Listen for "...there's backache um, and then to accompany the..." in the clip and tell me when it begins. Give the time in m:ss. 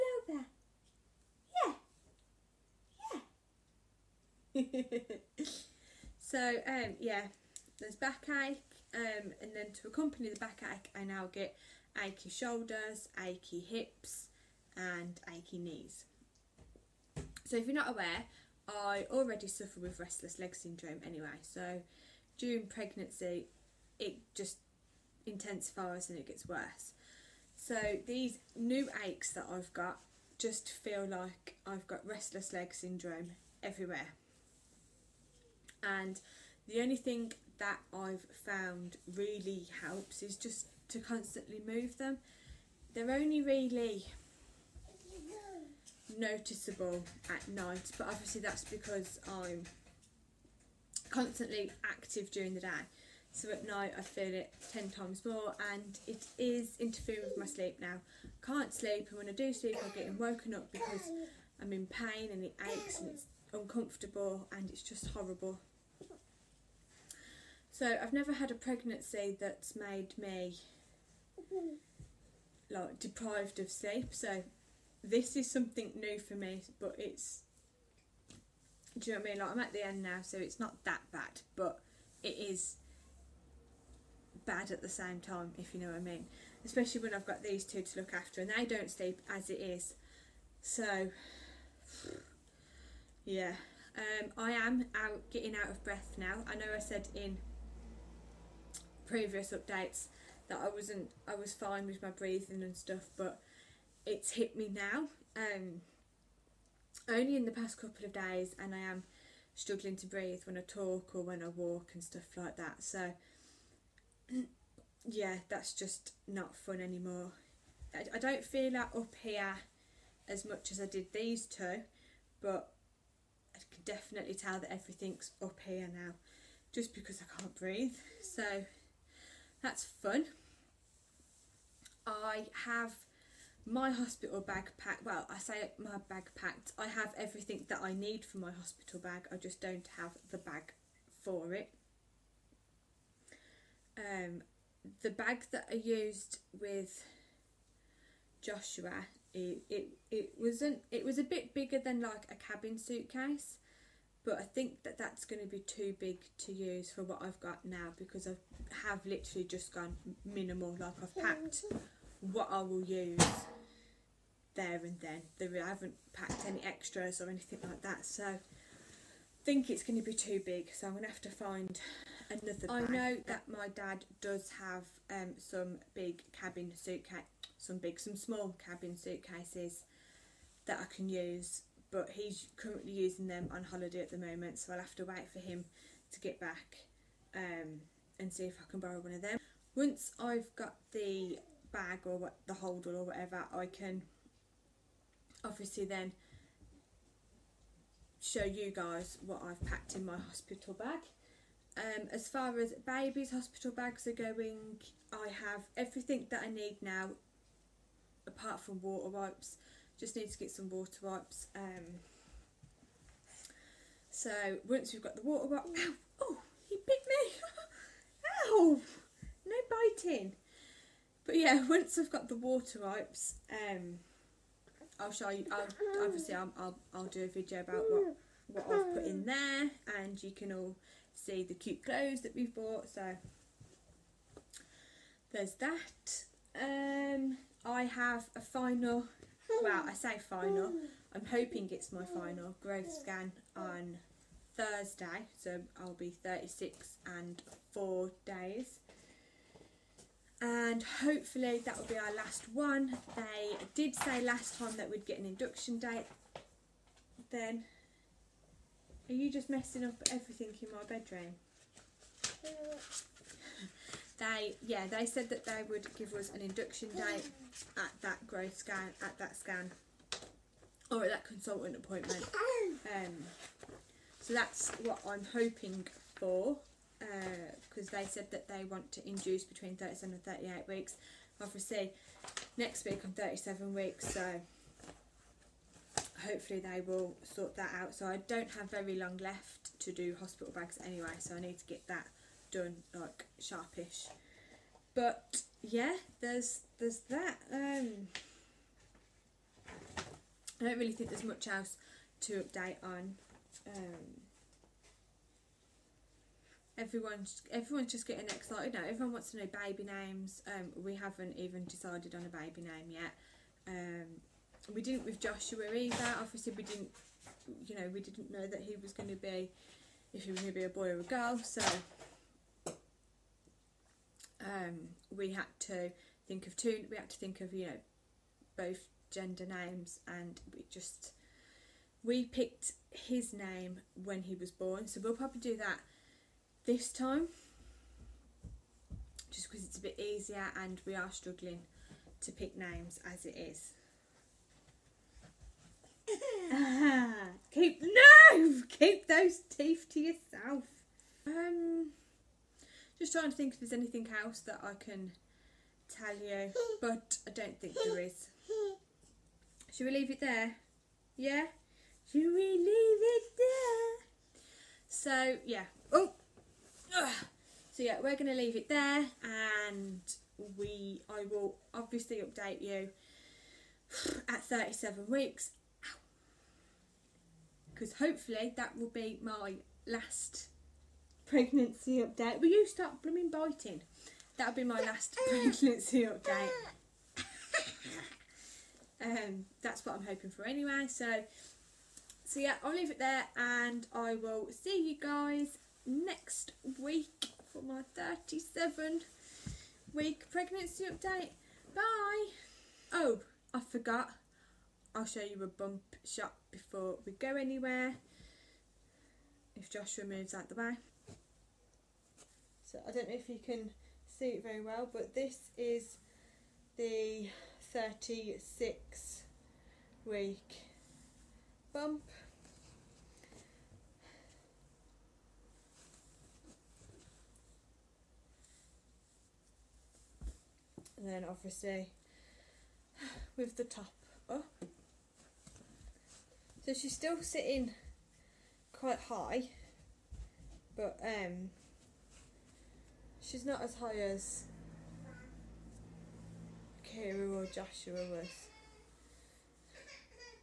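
0:07.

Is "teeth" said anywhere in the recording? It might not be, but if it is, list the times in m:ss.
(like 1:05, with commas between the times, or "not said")
5:49.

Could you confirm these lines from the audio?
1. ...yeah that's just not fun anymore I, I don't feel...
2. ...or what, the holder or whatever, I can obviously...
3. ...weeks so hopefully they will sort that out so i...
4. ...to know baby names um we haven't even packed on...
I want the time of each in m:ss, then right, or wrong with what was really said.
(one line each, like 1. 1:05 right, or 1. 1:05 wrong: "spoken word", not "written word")
1. 1:55 right
2. 3:12 right
3. 4:43 right
4. 5:09 wrong: "decided", not "packed".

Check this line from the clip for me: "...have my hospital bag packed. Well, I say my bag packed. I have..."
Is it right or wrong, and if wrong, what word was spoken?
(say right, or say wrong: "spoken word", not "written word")
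right.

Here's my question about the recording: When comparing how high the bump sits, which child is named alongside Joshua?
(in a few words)
Kira.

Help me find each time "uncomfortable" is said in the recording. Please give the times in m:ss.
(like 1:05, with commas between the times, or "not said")
1:03.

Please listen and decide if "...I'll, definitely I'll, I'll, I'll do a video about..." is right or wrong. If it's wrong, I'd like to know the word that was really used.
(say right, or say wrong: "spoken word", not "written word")
wrong: "obviously", not "definitely".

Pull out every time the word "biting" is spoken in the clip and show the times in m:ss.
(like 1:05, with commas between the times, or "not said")
3:40, 6:23.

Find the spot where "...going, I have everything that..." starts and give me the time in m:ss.
3:24.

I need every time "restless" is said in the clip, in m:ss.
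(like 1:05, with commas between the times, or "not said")
0:19, 0:32.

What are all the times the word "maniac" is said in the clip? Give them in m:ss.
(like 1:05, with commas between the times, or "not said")
not said.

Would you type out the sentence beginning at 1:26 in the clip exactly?
Especially when I've got these two to look after and they don't sleep as it is.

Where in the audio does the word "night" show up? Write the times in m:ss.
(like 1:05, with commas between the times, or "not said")
0:47, 0:53.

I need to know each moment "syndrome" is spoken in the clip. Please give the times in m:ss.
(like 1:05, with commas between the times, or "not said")
0:20, 0:32.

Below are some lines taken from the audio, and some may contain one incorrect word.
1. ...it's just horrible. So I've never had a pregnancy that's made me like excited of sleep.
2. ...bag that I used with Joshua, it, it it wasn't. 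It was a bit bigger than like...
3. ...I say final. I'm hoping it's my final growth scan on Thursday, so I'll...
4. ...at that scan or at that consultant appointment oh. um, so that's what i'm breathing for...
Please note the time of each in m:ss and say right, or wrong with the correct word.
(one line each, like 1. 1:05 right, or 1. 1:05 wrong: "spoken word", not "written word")
1. 1:04 wrong: "deprived", not "excited"
2. 2:25 right
3. 3:59 right
4. 4:29 wrong: "hoping", not "breathing".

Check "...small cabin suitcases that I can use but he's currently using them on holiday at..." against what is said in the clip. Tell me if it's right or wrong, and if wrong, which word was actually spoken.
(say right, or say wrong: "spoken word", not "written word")
right.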